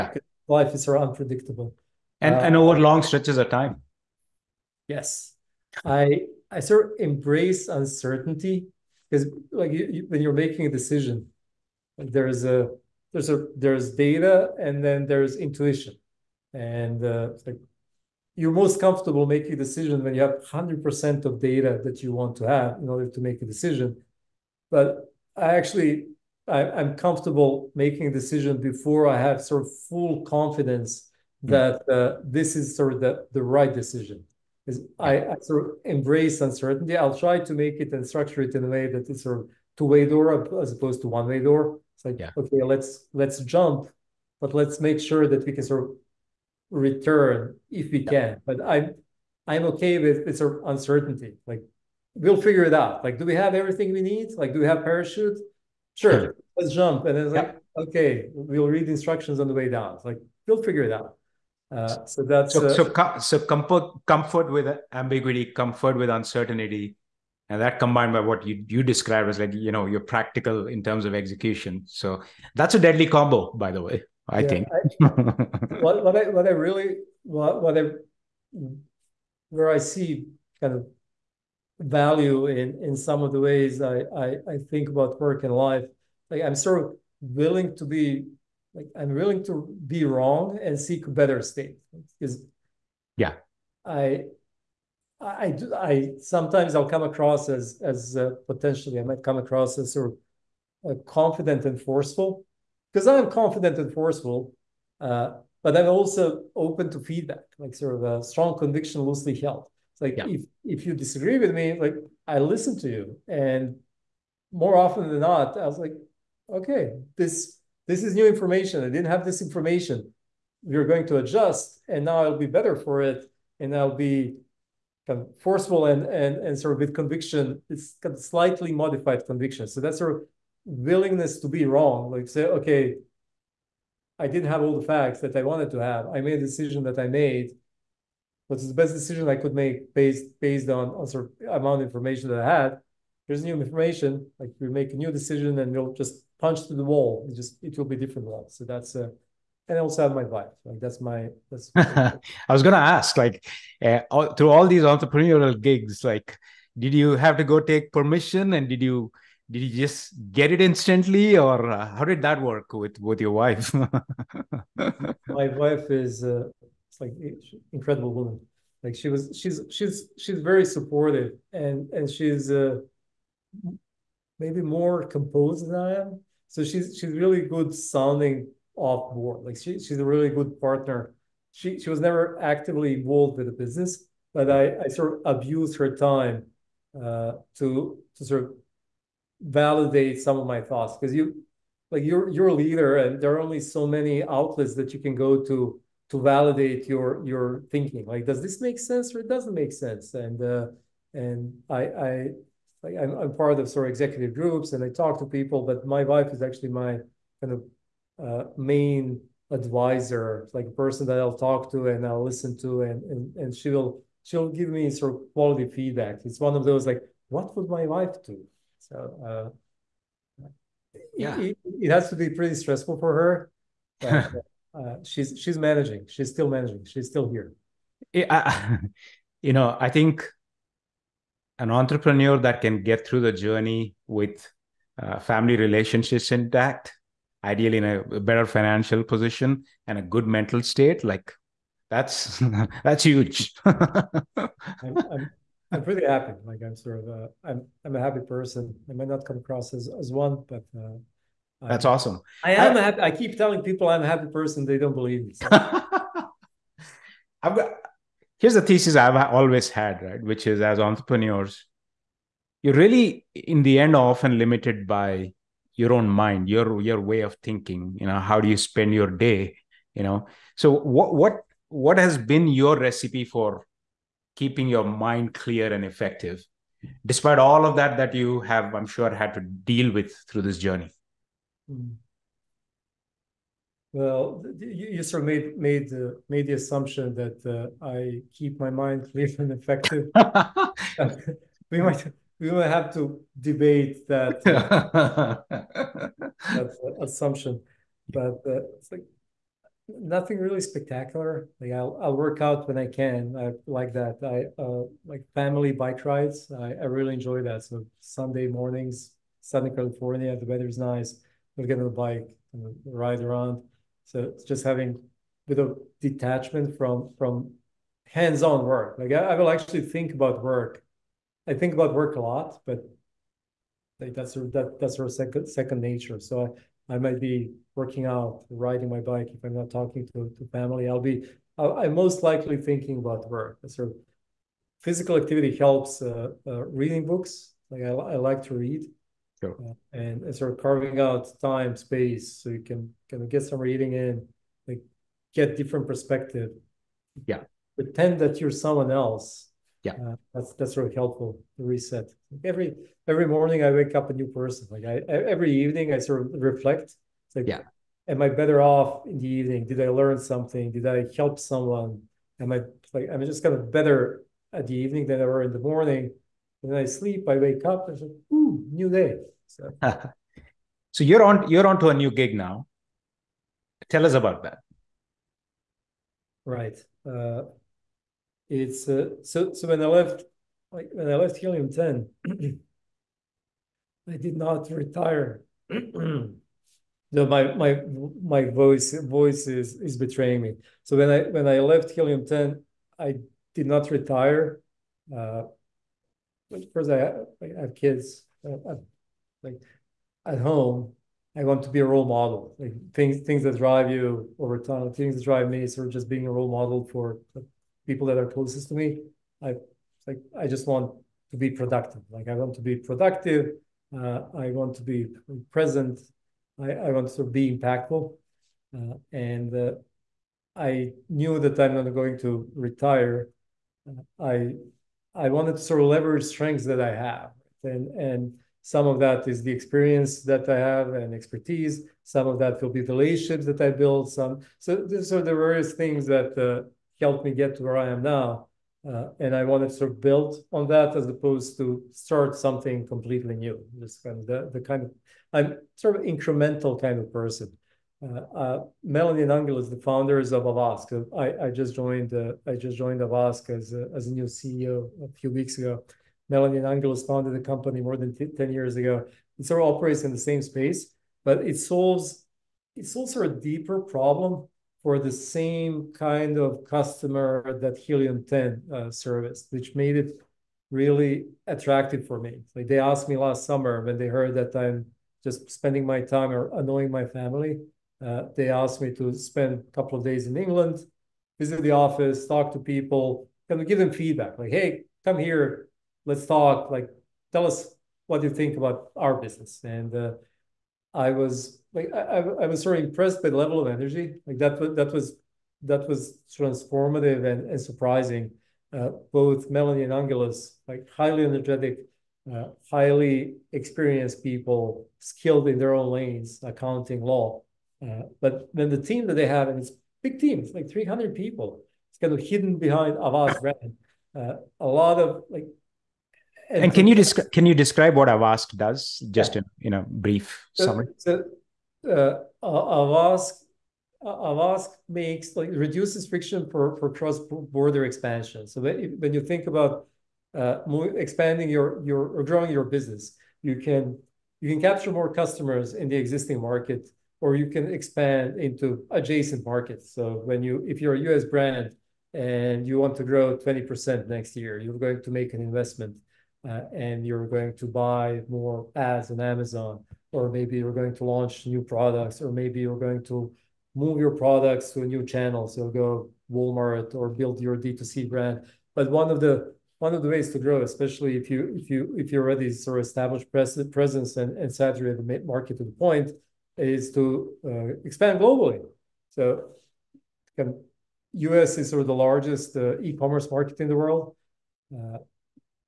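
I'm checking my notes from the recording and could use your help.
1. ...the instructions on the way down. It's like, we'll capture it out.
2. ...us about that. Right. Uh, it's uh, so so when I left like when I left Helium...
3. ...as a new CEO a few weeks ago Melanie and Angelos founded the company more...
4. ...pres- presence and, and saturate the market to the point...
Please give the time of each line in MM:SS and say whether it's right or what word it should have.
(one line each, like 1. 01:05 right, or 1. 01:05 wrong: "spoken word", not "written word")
1. 00:58 wrong: "figure", not "capture"
2. 06:14 right
3. 07:33 right
4. 09:23 right.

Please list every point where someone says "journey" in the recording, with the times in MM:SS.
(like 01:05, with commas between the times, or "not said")
03:53, 04:40.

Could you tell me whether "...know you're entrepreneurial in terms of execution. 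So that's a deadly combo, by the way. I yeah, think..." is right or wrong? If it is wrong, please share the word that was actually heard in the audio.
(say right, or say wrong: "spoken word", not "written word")
wrong: "practical", not "entrepreneurial".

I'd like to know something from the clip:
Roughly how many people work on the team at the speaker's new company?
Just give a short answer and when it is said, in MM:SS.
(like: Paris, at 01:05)
300, at 08:30.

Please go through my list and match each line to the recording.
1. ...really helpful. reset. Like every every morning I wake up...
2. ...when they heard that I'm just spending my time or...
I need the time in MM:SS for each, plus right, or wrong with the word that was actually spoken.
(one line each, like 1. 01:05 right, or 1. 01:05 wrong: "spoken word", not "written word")
1. 05:50 right
2. 07:53 right.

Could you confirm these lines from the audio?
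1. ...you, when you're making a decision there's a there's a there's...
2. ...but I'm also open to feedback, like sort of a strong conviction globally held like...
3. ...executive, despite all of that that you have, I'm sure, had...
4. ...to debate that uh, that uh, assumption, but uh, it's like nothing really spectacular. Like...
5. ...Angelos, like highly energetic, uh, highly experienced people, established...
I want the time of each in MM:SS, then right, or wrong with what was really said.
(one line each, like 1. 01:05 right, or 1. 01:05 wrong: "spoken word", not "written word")
1. 00:09 right
2. 01:45 wrong: "loosely", not "globally"
3. 04:35 wrong: "effective", not "executive"
4. 04:52 right
5. 08:19 wrong: "skilled", not "established".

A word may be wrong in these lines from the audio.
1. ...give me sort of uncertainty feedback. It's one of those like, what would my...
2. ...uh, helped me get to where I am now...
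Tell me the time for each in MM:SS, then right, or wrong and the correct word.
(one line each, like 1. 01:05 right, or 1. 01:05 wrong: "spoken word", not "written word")
1. 03:34 wrong: "quality", not "uncertainty"
2. 07:16 right.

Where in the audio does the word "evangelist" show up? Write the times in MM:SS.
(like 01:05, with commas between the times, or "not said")
not said.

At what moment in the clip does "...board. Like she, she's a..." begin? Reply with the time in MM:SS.
02:59.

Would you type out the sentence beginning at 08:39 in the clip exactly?
in, in a brief so, summary?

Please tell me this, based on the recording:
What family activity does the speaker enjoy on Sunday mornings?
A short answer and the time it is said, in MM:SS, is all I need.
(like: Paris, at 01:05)
bike rides, at 05:05.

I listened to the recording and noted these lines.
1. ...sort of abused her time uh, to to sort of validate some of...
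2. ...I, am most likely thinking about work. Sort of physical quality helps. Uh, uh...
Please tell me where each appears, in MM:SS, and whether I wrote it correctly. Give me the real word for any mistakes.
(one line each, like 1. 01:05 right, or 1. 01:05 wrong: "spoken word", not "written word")
1. 03:04 right
2. 05:31 wrong: "activity", not "quality".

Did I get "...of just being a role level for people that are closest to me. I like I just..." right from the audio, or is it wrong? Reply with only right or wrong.
wrong.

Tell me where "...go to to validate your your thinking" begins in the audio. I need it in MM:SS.
03:15.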